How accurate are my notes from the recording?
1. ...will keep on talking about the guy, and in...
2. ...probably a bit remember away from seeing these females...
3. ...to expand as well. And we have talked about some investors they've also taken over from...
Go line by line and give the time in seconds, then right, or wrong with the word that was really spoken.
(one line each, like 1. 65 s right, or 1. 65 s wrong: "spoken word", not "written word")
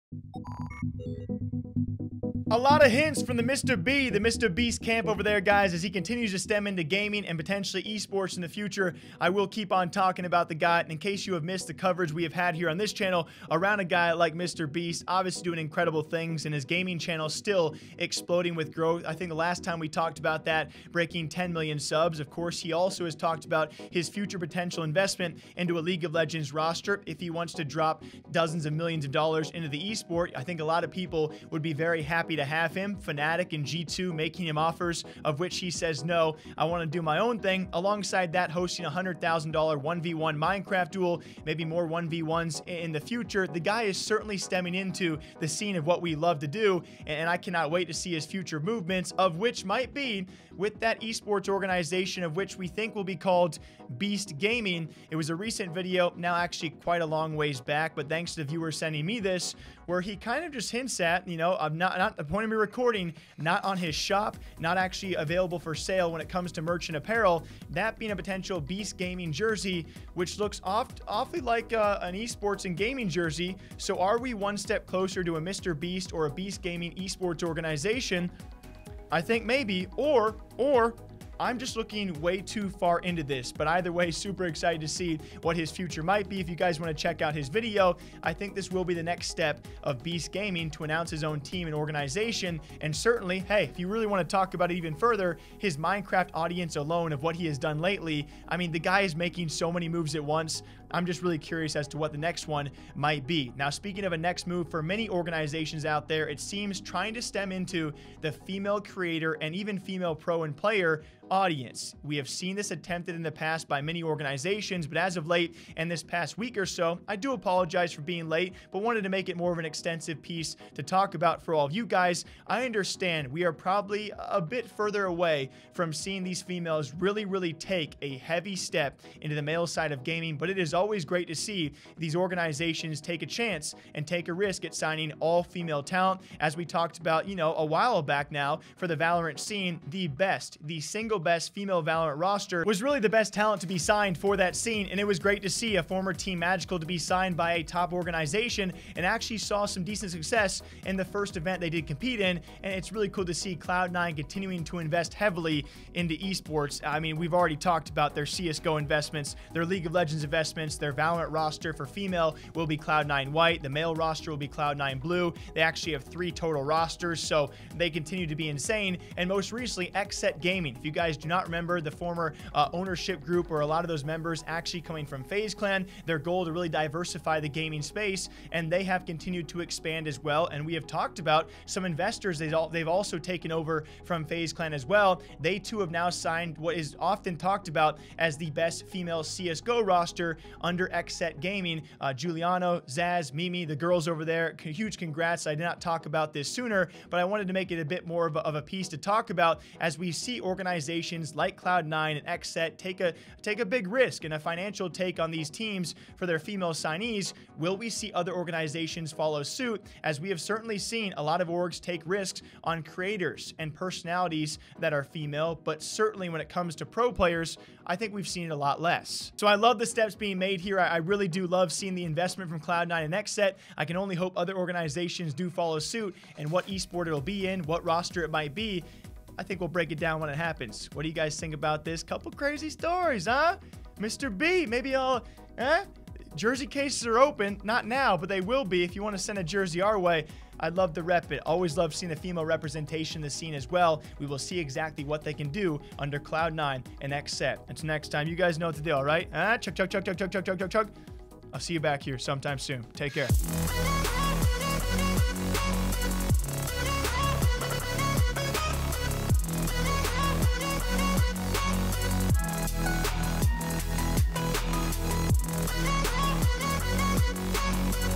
1. 9 s right
2. 123 s wrong: "further", not "remember"
3. 179 s right.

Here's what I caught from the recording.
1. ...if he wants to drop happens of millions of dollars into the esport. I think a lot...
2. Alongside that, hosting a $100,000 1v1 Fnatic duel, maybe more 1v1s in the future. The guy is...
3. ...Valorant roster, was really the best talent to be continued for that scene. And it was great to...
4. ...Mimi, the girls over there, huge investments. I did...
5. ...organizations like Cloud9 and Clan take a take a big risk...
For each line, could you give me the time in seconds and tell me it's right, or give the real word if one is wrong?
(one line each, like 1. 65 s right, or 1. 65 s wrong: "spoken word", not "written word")
1. 27 s wrong: "dozens", not "happens"
2. 37 s wrong: "Minecraft", not "Fnatic"
3. 141 s wrong: "signed", not "continued"
4. 193 s wrong: "congrats", not "investments"
5. 200 s wrong: "Xset", not "Clan".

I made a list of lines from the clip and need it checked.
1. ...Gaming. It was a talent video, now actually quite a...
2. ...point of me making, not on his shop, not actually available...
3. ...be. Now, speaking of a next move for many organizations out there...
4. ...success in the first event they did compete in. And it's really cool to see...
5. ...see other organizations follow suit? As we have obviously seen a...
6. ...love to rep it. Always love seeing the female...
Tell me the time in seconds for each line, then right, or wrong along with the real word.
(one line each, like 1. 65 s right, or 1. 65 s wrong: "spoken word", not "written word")
1. 54 s wrong: "recent", not "talent"
2. 62 s wrong: "recording", not "making"
3. 103 s right
4. 150 s right
5. 207 s wrong: "certainly", not "obviously"
6. 240 s right.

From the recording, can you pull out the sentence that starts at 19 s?
I think the last time we talked about that, breaking 10 million subs.